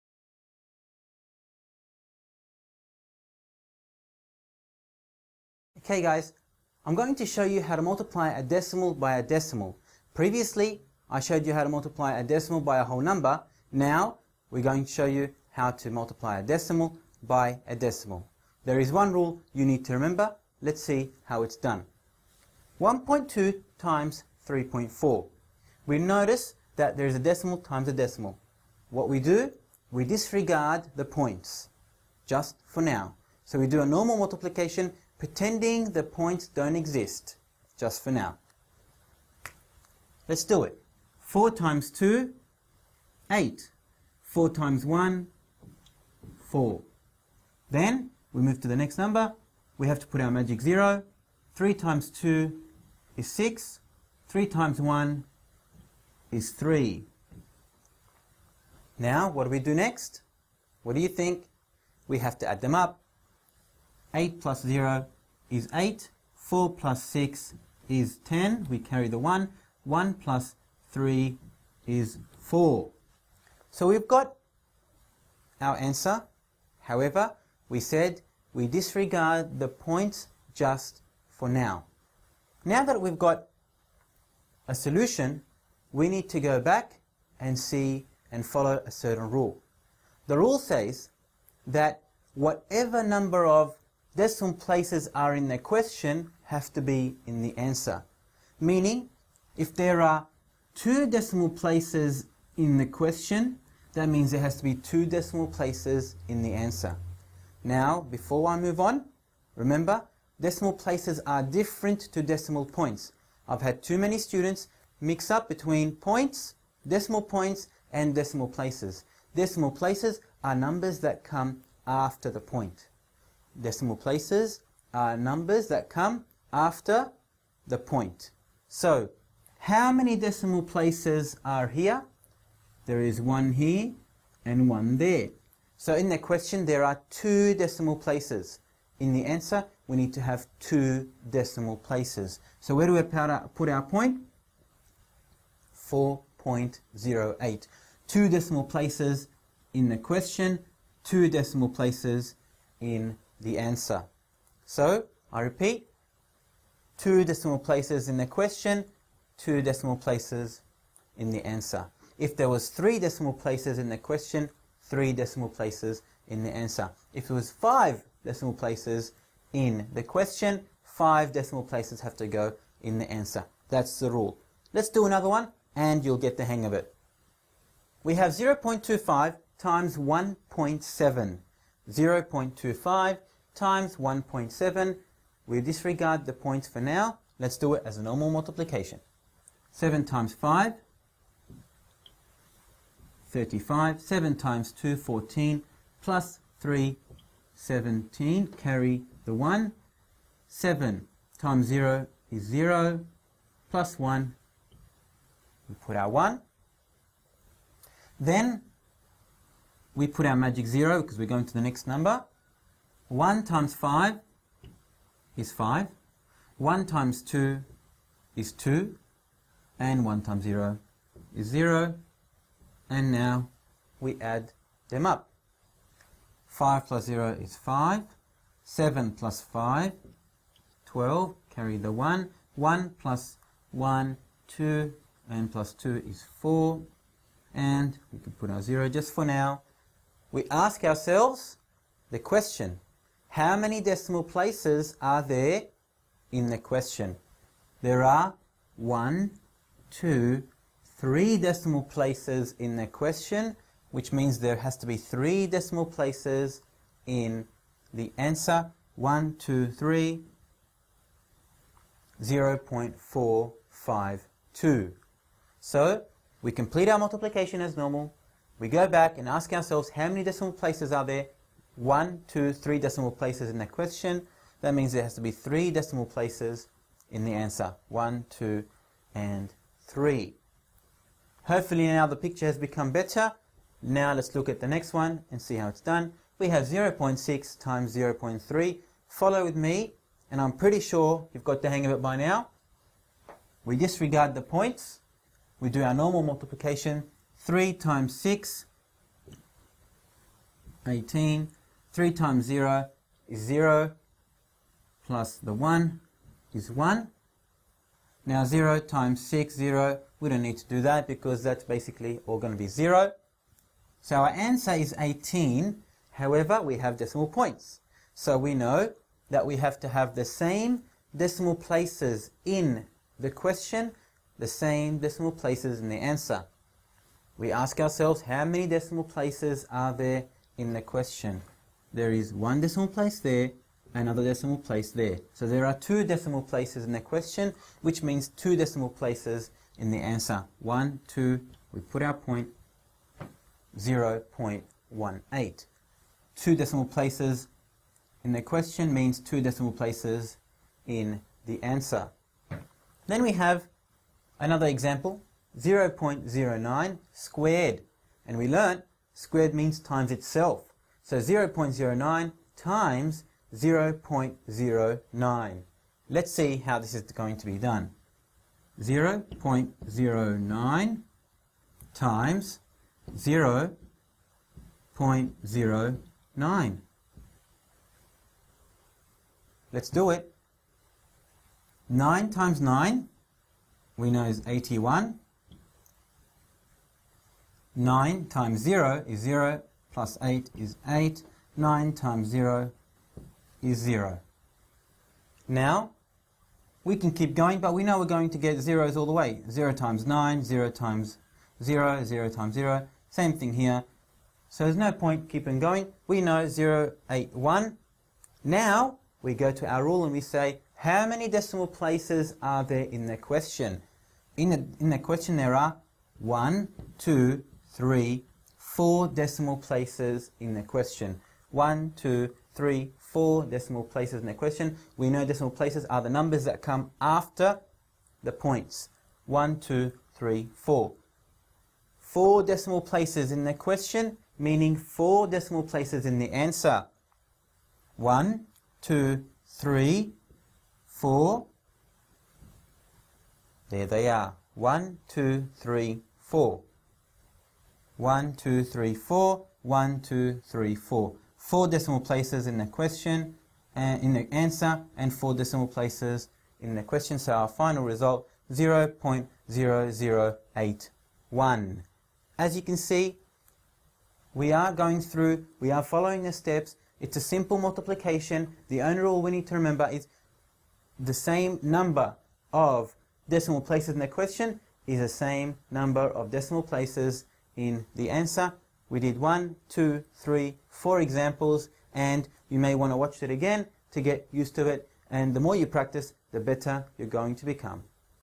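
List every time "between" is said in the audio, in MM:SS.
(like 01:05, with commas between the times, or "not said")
01:55.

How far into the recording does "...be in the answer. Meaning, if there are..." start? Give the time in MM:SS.
01:36.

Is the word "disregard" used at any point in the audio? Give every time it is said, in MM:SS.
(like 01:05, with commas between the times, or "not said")
00:30, 01:18, 03:05, 04:53.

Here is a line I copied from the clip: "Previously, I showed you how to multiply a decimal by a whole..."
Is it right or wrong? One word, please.
right.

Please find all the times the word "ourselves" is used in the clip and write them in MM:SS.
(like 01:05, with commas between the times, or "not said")
04:00, 04:29, 05:27.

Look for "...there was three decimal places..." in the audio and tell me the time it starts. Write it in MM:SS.
02:42.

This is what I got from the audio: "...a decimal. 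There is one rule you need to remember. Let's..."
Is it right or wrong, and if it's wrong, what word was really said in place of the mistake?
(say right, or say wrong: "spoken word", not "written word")
right.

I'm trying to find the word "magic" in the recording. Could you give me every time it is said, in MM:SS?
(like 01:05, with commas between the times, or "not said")
00:50, 03:30.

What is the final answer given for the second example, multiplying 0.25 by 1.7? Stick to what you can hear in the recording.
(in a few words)
0.452.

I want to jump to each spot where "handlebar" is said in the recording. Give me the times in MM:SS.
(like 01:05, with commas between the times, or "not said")
not said.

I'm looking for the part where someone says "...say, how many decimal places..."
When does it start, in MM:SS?
06:50.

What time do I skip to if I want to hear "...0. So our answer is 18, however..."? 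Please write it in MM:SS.
05:12.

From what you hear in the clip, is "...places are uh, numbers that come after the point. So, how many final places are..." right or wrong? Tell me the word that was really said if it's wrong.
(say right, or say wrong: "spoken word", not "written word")
wrong: "decimal", not "final".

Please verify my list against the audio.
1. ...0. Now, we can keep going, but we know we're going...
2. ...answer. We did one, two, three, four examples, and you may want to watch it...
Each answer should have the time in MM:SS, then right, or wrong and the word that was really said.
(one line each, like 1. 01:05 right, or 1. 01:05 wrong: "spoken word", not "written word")
1. 06:33 right
2. 07:58 right.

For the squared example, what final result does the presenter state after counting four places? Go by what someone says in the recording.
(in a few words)
0.0081.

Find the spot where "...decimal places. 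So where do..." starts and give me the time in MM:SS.
02:21.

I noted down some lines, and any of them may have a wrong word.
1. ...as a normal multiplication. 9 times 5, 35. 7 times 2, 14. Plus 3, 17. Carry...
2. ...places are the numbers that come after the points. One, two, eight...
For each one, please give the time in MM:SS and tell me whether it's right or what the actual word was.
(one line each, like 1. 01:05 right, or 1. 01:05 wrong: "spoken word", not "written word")
1. 03:07 wrong: "7", not "9"
2. 07:05 wrong: "three", not "eight".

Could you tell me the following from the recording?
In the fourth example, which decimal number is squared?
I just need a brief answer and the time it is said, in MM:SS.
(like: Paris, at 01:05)
0.09, at 05:55.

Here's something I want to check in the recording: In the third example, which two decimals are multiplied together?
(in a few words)
0.6 times 0.3.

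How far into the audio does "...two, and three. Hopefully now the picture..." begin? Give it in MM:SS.
04:38.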